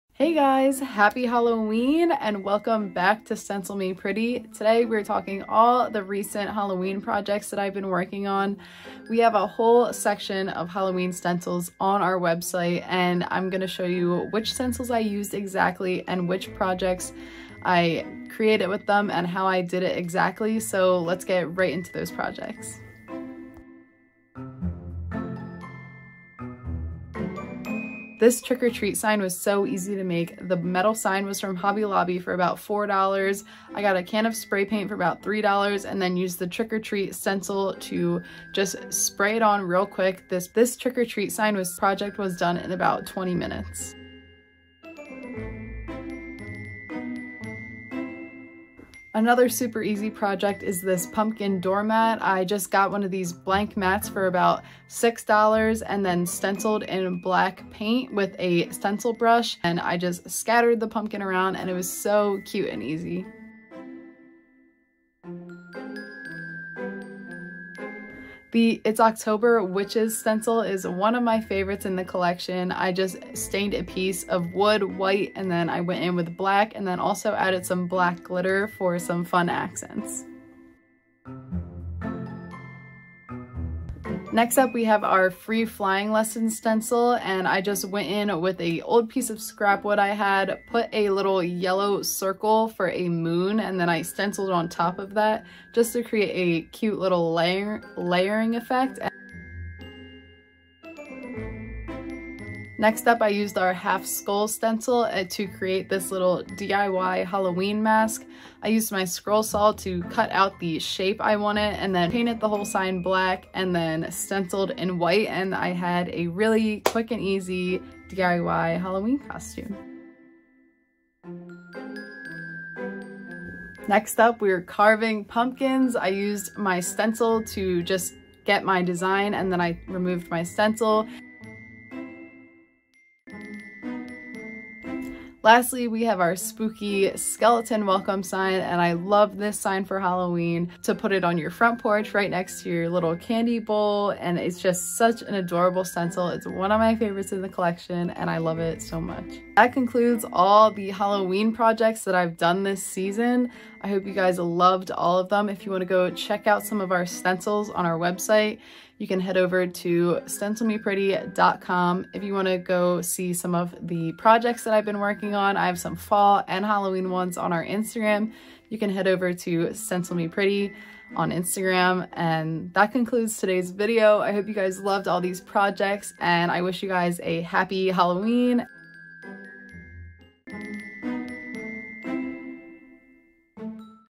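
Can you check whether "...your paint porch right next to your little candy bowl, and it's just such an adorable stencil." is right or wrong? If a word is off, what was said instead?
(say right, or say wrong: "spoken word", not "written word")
wrong: "front", not "paint".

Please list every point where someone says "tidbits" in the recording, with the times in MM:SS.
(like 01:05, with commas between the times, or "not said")
not said.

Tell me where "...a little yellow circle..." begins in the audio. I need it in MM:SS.
01:30.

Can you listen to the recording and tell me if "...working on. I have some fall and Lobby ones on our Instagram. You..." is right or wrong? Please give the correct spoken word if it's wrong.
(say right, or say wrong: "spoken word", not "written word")
wrong: "Halloween", not "Lobby".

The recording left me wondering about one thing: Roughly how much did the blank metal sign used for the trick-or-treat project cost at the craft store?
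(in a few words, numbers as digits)
$4.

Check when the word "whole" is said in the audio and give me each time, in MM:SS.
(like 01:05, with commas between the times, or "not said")
00:09, 01:52.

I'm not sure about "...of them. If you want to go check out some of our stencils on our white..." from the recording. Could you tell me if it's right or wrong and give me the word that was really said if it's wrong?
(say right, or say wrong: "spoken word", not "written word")
wrong: "website", not "white".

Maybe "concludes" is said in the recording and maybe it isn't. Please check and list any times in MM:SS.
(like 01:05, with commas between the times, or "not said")
02:29, 02:52.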